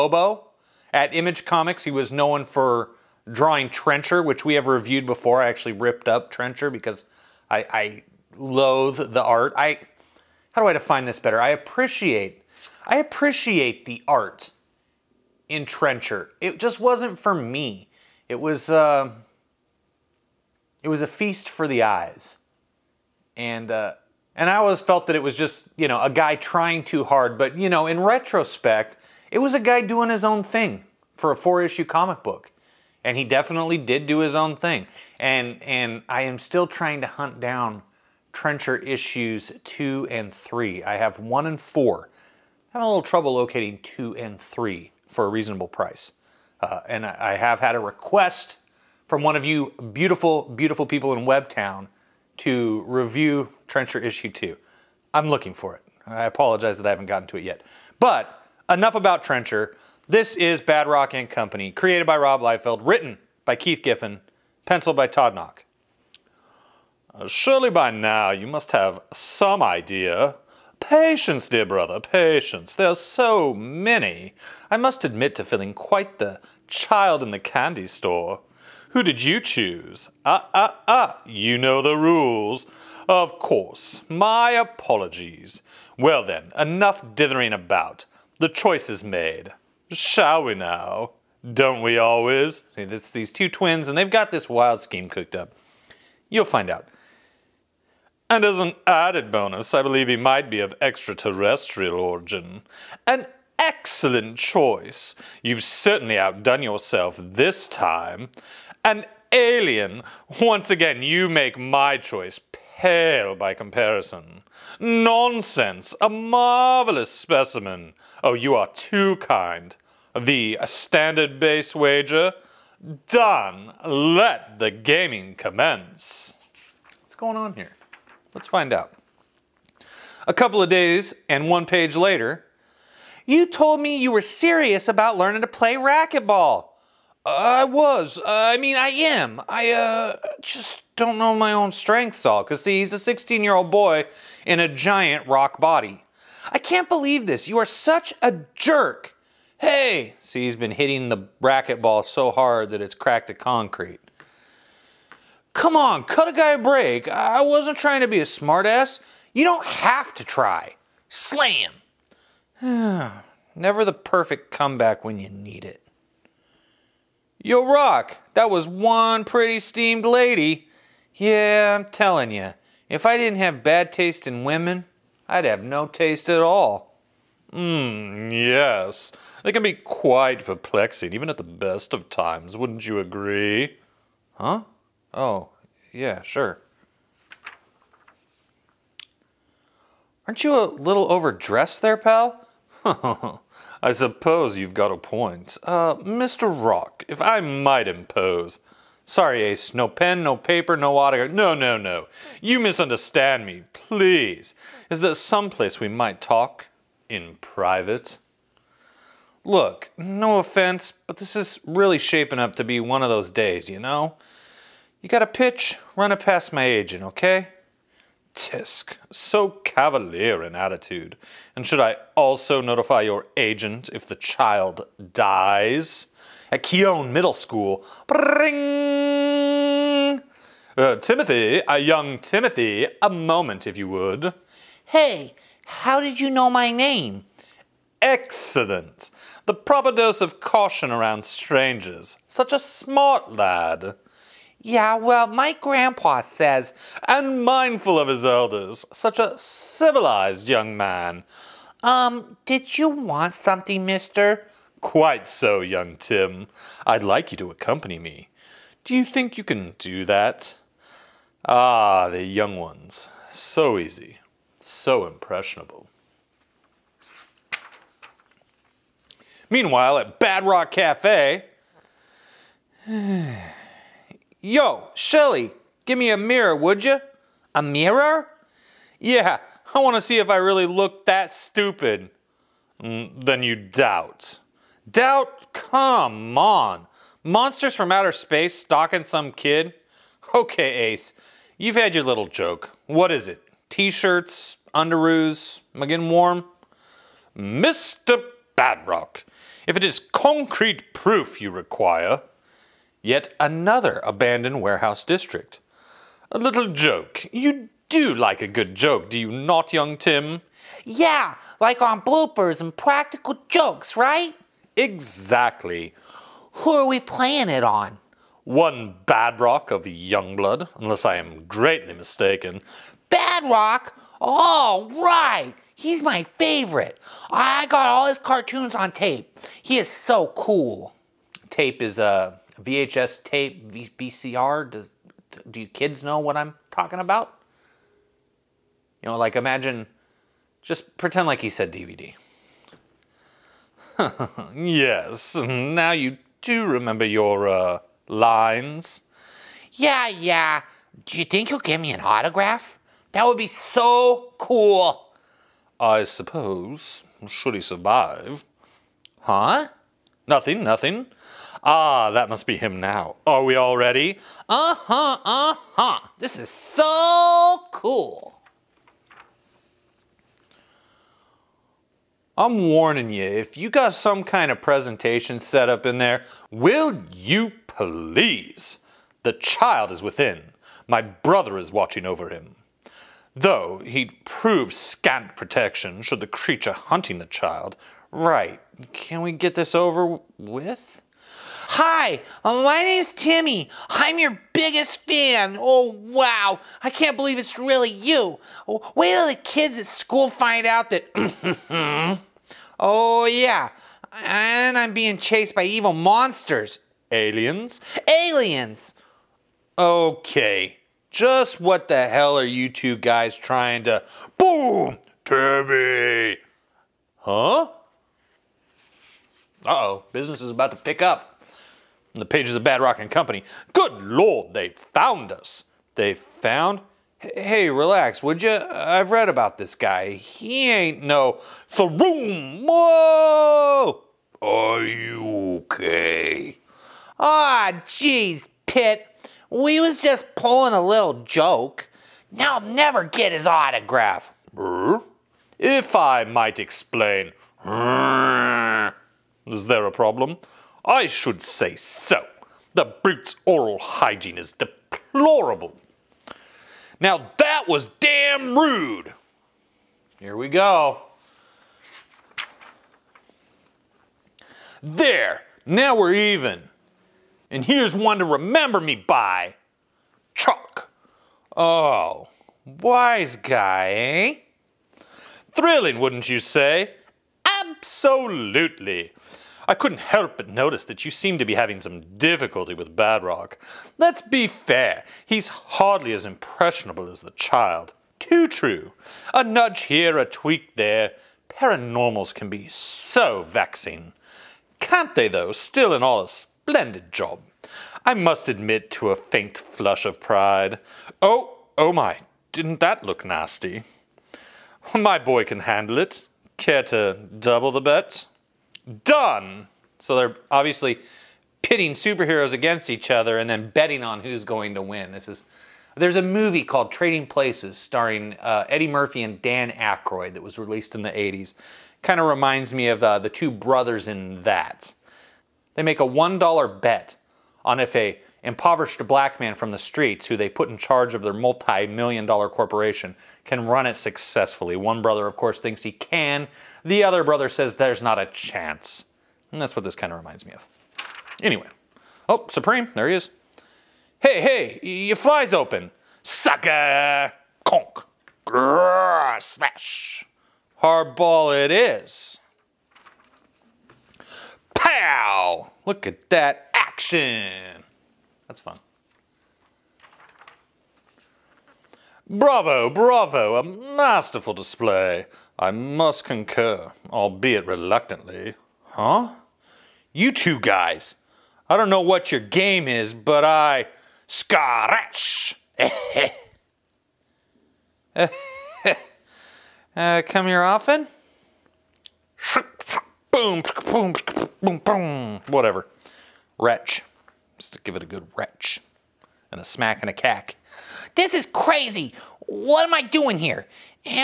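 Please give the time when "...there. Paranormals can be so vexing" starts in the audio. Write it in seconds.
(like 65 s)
490 s.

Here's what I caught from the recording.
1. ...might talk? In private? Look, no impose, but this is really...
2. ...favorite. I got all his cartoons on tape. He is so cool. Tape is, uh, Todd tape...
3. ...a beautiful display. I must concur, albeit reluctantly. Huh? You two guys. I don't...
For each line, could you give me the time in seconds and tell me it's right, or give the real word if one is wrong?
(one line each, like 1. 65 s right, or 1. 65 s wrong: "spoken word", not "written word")
1. 205 s wrong: "offense", not "impose"
2. 326 s wrong: "VHS", not "Todd"
3. 563 s wrong: "masterful", not "beautiful".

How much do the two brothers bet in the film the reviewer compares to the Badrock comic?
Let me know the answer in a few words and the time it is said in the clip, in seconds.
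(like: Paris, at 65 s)
$1, at 526 s.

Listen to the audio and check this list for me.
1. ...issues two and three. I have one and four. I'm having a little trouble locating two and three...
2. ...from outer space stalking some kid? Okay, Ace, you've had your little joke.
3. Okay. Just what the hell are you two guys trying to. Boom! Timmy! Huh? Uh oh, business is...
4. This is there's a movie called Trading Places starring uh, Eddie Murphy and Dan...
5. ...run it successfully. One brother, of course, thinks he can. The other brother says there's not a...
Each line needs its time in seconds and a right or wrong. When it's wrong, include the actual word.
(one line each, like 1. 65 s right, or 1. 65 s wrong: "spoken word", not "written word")
1. 38 s right
2. 287 s right
3. 409 s right
4. 515 s right
5. 533 s right.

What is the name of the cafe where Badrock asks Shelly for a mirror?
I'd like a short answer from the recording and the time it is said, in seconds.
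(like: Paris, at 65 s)
Bad Rock Cafe, at 270 s.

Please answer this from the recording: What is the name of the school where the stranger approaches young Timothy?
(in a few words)
Keown Middle School.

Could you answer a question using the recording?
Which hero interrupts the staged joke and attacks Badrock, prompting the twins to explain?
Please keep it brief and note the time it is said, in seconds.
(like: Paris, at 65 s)
Pitt, at 438 s.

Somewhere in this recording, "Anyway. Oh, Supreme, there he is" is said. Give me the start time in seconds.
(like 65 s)
541 s.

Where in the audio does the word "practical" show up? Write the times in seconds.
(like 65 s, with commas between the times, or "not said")
312 s.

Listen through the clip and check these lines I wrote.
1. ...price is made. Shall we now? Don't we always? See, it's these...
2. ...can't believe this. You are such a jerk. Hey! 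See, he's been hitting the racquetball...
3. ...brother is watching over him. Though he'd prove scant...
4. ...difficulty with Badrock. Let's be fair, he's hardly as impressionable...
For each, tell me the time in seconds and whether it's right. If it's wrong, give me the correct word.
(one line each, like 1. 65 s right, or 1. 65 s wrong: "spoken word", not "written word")
1. 88 s wrong: "choice", not "price"
2. 146 s right
3. 381 s right
4. 482 s right.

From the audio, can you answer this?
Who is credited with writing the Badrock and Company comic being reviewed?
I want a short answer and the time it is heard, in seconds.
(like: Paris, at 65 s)
Keith Giffen, at 63 s.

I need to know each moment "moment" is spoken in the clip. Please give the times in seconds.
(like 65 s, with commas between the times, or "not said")
233 s.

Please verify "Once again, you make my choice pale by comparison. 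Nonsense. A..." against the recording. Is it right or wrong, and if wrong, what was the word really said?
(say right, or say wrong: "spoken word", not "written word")
right.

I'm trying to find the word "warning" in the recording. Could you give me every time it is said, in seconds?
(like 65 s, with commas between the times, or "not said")
372 s.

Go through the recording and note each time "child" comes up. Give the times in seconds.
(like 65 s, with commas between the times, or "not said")
76 s, 224 s, 379 s, 387 s, 487 s.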